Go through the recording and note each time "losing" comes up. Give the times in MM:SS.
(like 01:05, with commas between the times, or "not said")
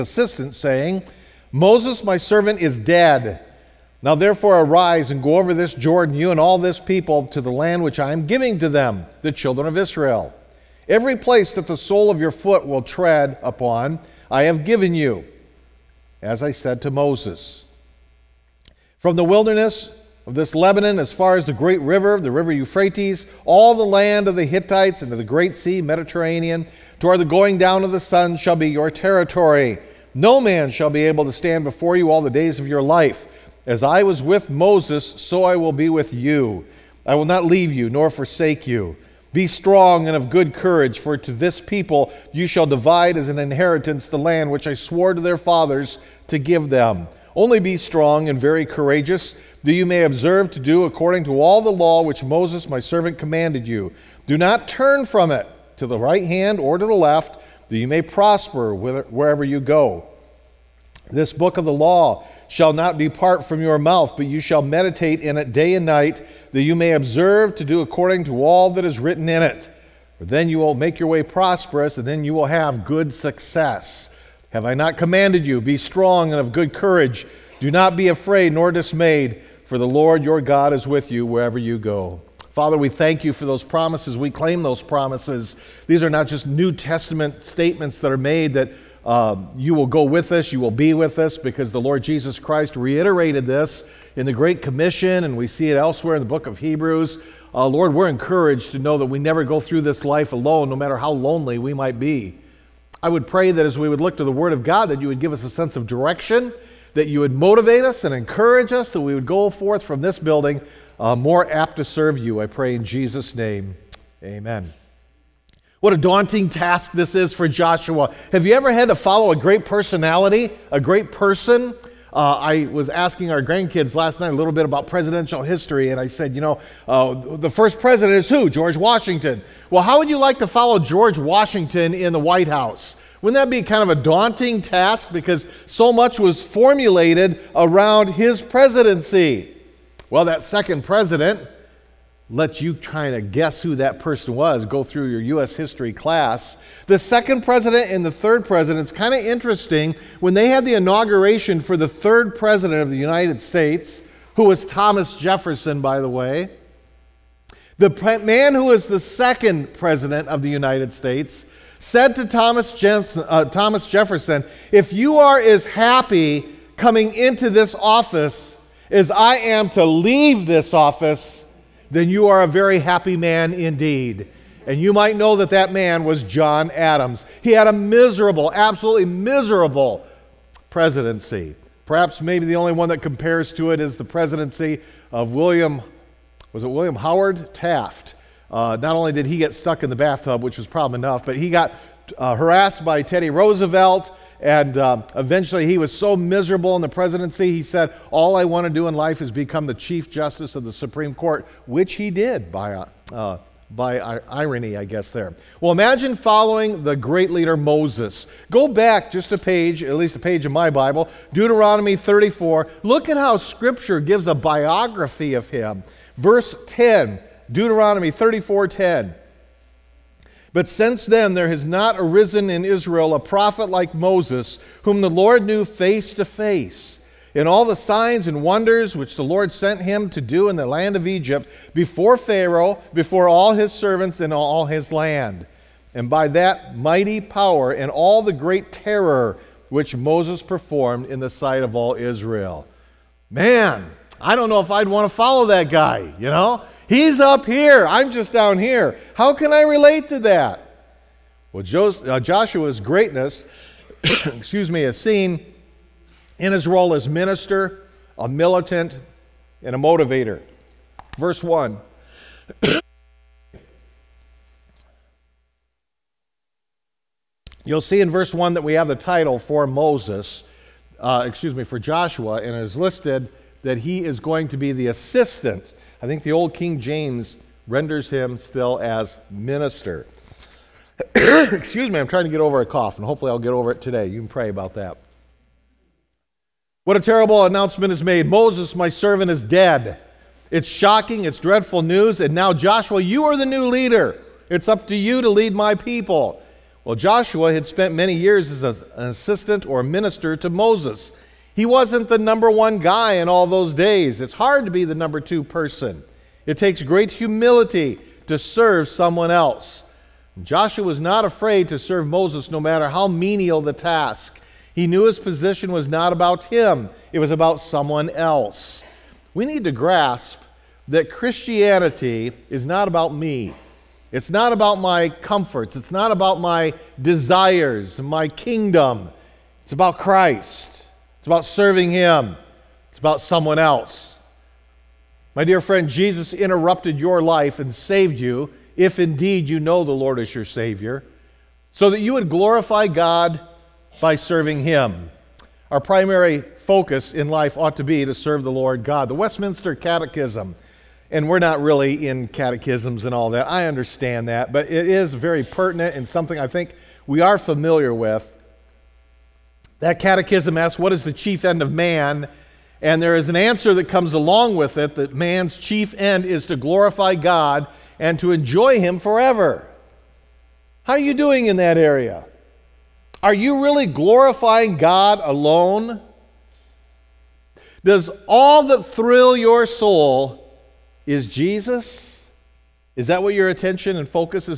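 not said.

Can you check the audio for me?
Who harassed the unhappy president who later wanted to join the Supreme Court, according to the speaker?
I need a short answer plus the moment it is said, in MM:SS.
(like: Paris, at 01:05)
Teddy Roosevelt, at 03:13.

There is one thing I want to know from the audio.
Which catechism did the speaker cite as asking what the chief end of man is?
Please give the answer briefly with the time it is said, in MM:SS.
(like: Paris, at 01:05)
Westminster Catechism, at 05:49.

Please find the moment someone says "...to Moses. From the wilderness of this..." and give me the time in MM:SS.
00:16.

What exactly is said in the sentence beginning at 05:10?
Joshua was not afraid to serve Moses no matter how menial the task.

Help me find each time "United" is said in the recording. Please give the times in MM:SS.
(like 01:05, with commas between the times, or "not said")
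02:32, 02:40.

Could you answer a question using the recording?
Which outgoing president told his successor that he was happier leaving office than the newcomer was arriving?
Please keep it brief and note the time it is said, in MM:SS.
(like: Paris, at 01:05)
John Adams, at 02:56.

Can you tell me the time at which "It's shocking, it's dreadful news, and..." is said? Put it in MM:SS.
04:50.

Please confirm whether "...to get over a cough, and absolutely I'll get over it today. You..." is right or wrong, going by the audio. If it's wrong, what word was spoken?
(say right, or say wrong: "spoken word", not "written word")
wrong: "hopefully", not "absolutely".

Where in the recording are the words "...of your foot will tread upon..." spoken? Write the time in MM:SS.
00:12.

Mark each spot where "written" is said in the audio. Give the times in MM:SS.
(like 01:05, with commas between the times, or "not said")
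01:08.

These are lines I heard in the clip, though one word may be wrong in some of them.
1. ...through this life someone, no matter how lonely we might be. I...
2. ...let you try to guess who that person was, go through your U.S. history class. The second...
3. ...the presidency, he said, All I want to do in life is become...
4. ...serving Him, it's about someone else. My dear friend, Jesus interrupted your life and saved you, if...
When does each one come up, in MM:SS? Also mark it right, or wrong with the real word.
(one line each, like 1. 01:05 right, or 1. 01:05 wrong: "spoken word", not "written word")
1. 01:39 wrong: "alone", not "someone"
2. 02:22 right
3. 03:16 right
4. 05:31 right.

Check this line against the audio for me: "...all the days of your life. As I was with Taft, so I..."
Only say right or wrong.
wrong.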